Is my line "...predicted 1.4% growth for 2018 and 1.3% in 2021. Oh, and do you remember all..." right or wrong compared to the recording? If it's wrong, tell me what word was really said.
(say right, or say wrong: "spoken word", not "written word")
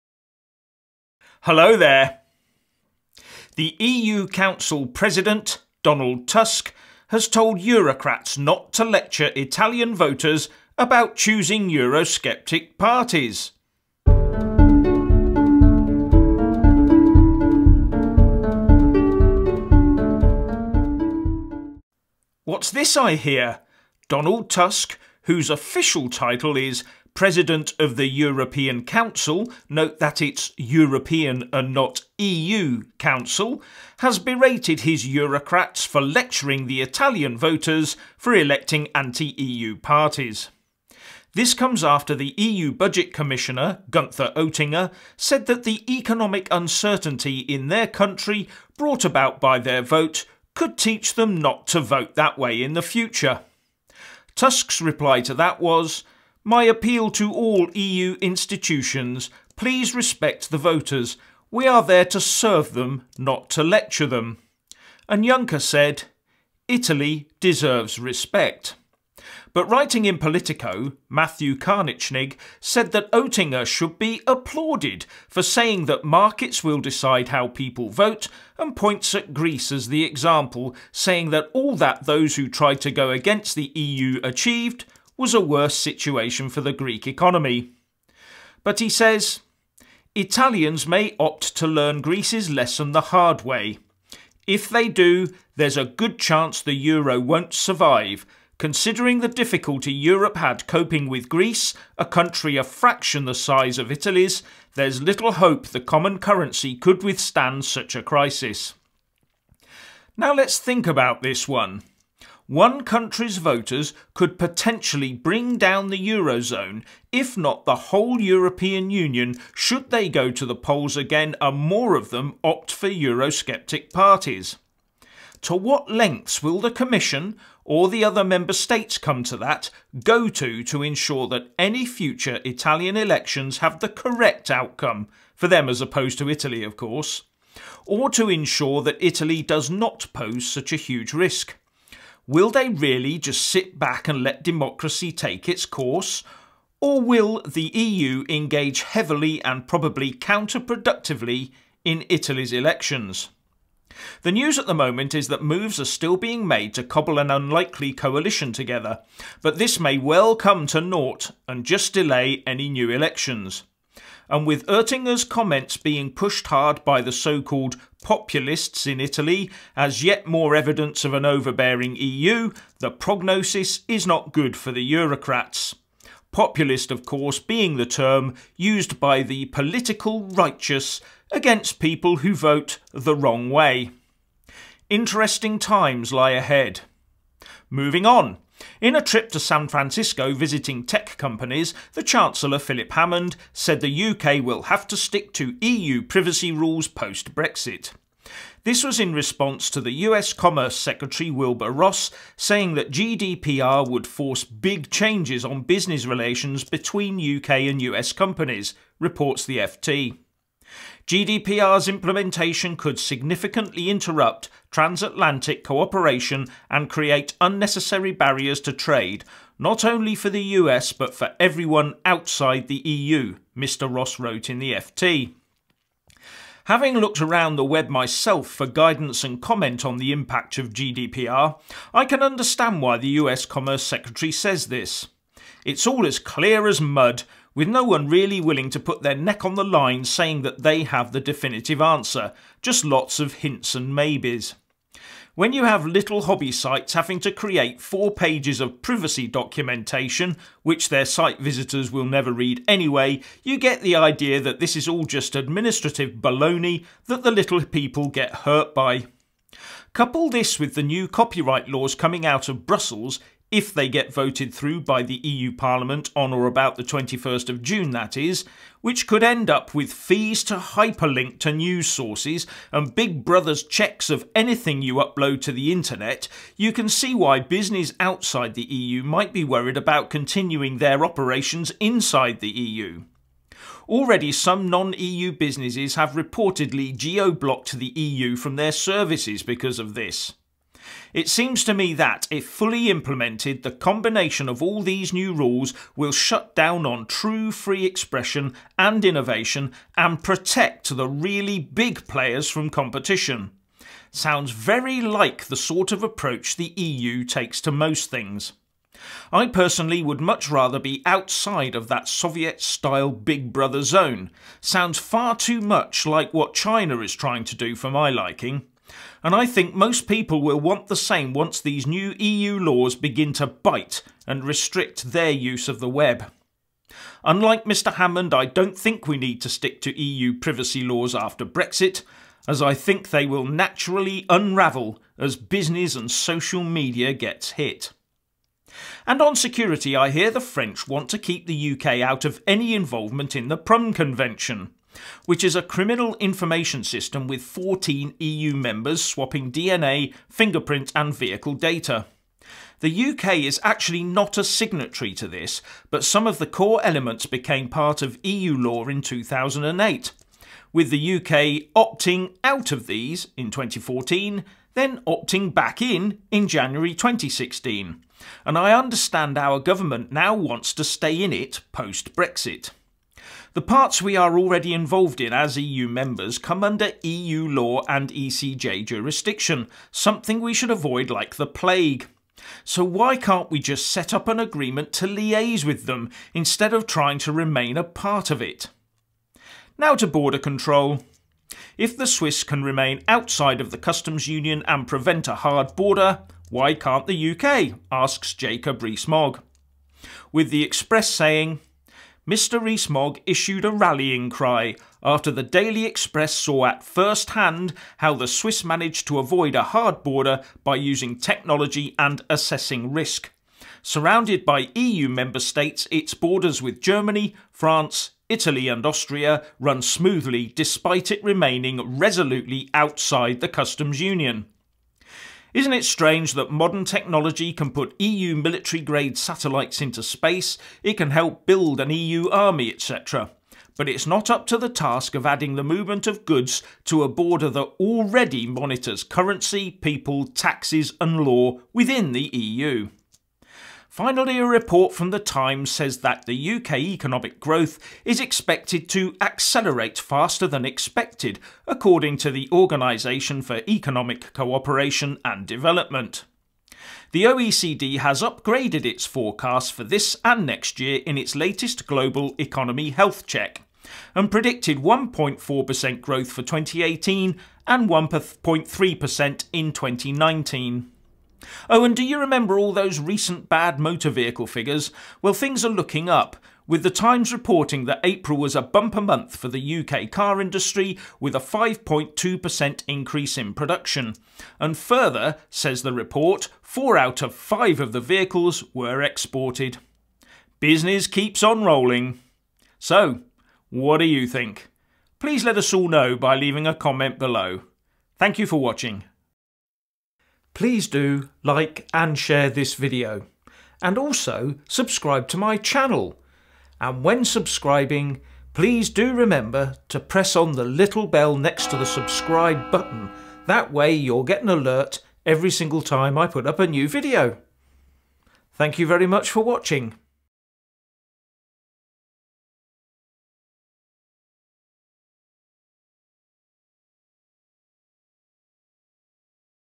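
wrong: "2019", not "2021".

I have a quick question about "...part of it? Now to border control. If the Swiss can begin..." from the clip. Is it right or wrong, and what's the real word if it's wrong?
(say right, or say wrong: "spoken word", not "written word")
wrong: "remain", not "begin".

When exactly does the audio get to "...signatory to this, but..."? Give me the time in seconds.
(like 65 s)
354 s.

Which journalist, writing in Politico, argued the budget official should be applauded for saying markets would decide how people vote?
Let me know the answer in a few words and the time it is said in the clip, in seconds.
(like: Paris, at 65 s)
Matthew Karnitschnig, at 71 s.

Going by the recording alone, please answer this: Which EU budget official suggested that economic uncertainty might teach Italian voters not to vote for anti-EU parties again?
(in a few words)
Gunther Oettinger.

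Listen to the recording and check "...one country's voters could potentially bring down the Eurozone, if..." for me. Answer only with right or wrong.
right.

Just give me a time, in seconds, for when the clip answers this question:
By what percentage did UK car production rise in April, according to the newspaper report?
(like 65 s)
481 s.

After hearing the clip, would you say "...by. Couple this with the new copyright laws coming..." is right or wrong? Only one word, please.
right.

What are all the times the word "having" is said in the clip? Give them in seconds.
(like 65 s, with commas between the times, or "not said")
226 s, 246 s.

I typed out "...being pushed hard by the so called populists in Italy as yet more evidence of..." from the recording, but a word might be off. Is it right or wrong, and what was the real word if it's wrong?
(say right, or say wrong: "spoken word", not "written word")
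right.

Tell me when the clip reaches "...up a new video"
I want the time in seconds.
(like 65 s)
516 s.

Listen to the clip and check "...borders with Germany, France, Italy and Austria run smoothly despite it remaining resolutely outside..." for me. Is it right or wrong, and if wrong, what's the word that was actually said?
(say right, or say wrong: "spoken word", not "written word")
right.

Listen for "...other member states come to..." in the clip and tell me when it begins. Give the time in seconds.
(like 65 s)
128 s.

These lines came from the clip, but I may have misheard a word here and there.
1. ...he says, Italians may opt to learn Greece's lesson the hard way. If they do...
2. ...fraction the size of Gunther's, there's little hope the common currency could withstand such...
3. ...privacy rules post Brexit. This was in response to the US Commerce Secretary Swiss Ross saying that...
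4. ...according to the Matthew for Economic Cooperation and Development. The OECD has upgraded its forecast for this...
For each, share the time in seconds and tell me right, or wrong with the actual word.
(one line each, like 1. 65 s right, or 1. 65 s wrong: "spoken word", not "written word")
1. 88 s right
2. 102 s wrong: "Italy", not "Gunther"
3. 196 s wrong: "Wilbur", not "Swiss"
4. 451 s wrong: "Organisation", not "Matthew".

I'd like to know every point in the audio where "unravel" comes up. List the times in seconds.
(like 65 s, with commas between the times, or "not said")
334 s.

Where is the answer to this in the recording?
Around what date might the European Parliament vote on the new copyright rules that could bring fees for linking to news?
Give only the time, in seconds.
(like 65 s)
266 s.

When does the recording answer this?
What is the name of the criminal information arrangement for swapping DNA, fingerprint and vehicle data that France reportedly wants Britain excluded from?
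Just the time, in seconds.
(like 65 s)
343 s.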